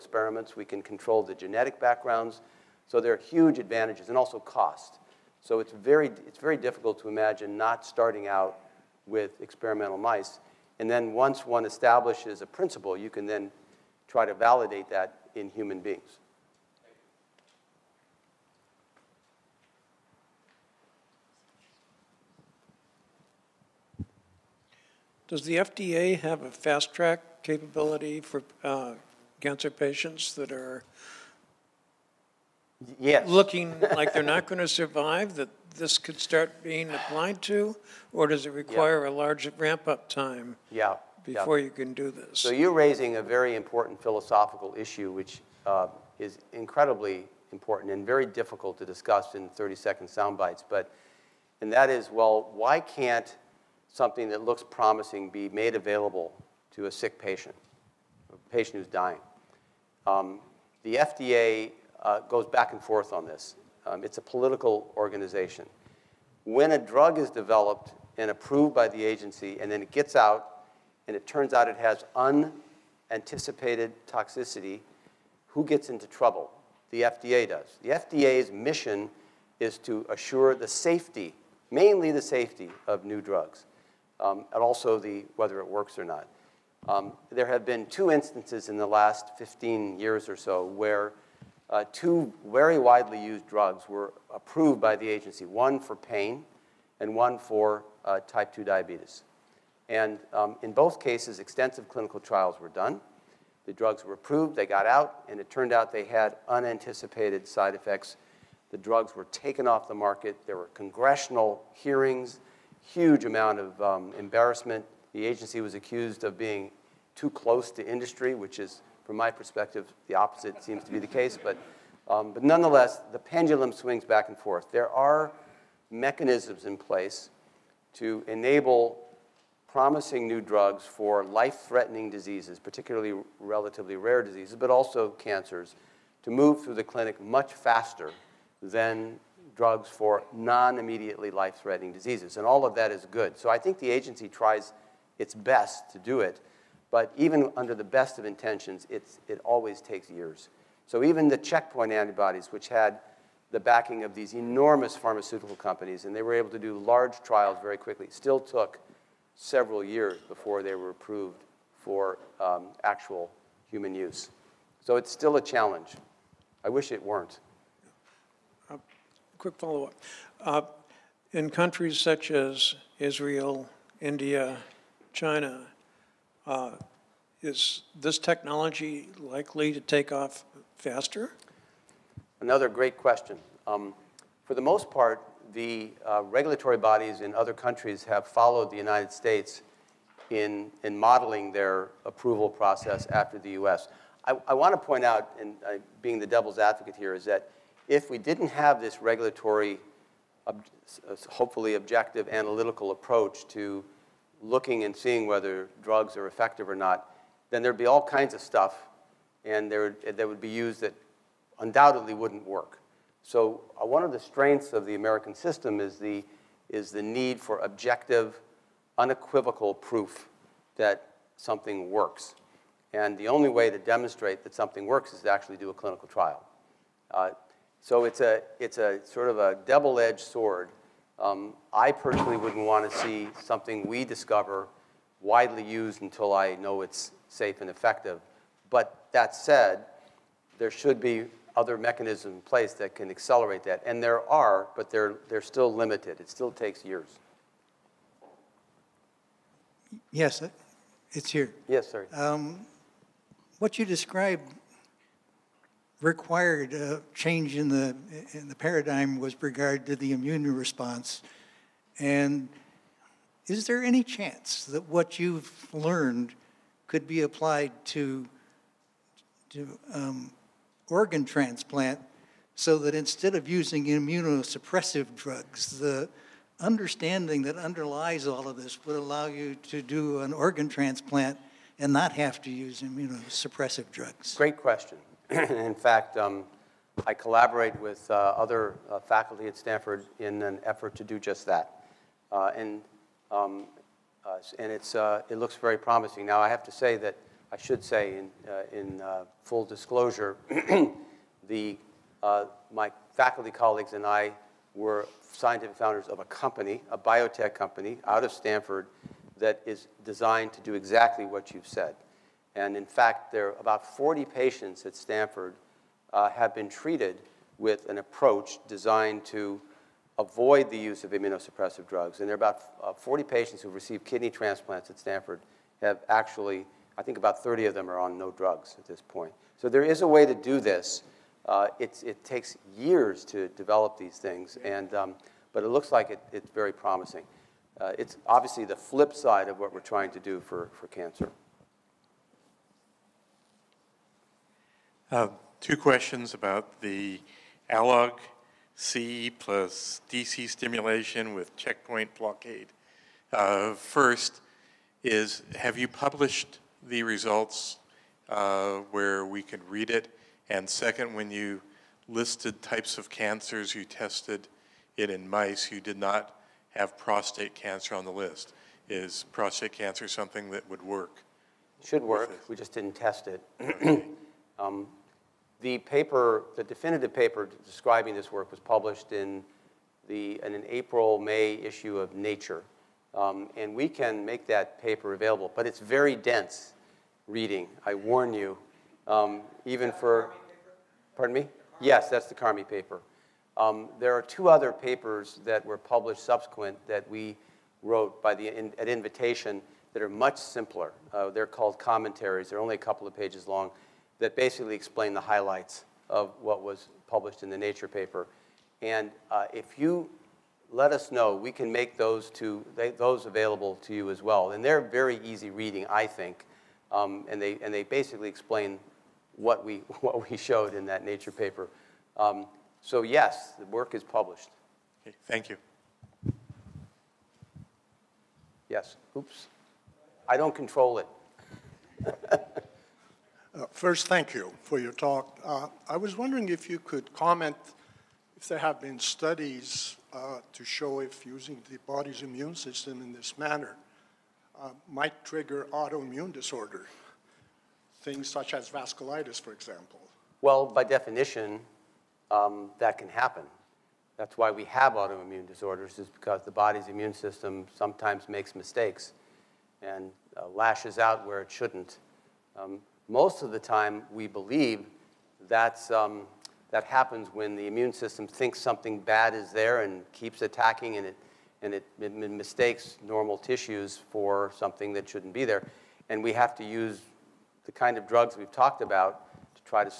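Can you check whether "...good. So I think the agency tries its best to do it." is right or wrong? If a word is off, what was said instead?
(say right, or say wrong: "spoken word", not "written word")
right.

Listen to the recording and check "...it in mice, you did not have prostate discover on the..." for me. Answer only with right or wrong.
wrong.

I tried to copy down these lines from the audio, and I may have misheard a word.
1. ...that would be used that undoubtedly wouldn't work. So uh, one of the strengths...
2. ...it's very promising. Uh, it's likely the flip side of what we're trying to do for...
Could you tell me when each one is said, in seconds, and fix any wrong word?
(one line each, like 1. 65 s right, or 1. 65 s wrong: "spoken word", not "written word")
1. 210 s right
2. 336 s wrong: "obviously", not "likely".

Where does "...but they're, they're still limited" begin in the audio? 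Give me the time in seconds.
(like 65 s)
244 s.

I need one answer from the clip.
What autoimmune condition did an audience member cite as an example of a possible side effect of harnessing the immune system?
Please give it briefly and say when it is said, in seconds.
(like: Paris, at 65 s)
vasculitis, at 448 s.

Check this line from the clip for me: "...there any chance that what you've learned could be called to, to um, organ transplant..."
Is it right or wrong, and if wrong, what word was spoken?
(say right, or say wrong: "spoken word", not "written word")
wrong: "applied", not "called".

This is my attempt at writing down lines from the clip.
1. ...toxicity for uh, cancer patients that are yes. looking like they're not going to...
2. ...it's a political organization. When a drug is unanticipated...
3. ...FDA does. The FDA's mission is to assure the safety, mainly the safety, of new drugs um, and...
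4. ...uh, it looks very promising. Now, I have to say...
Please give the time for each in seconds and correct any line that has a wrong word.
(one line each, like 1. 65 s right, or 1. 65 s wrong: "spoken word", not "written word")
1. 27 s wrong: "capability", not "toxicity"
2. 64 s wrong: "developed", not "unanticipated"
3. 77 s right
4. 294 s right.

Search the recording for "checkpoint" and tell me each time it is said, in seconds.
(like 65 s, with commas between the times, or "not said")
151 s, 351 s.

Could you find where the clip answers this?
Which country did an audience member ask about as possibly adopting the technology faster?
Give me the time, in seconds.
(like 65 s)
172 s.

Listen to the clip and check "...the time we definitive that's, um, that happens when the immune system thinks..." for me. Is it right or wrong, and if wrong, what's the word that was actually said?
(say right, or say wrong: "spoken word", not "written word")
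wrong: "believe", not "definitive".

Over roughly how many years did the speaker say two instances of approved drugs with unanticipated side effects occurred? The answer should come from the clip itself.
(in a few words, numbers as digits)
15 years.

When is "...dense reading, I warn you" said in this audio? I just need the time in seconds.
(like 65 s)
386 s.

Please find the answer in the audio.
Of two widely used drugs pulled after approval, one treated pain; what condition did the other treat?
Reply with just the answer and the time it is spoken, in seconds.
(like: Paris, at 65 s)
type 2 diabetes, at 98 s.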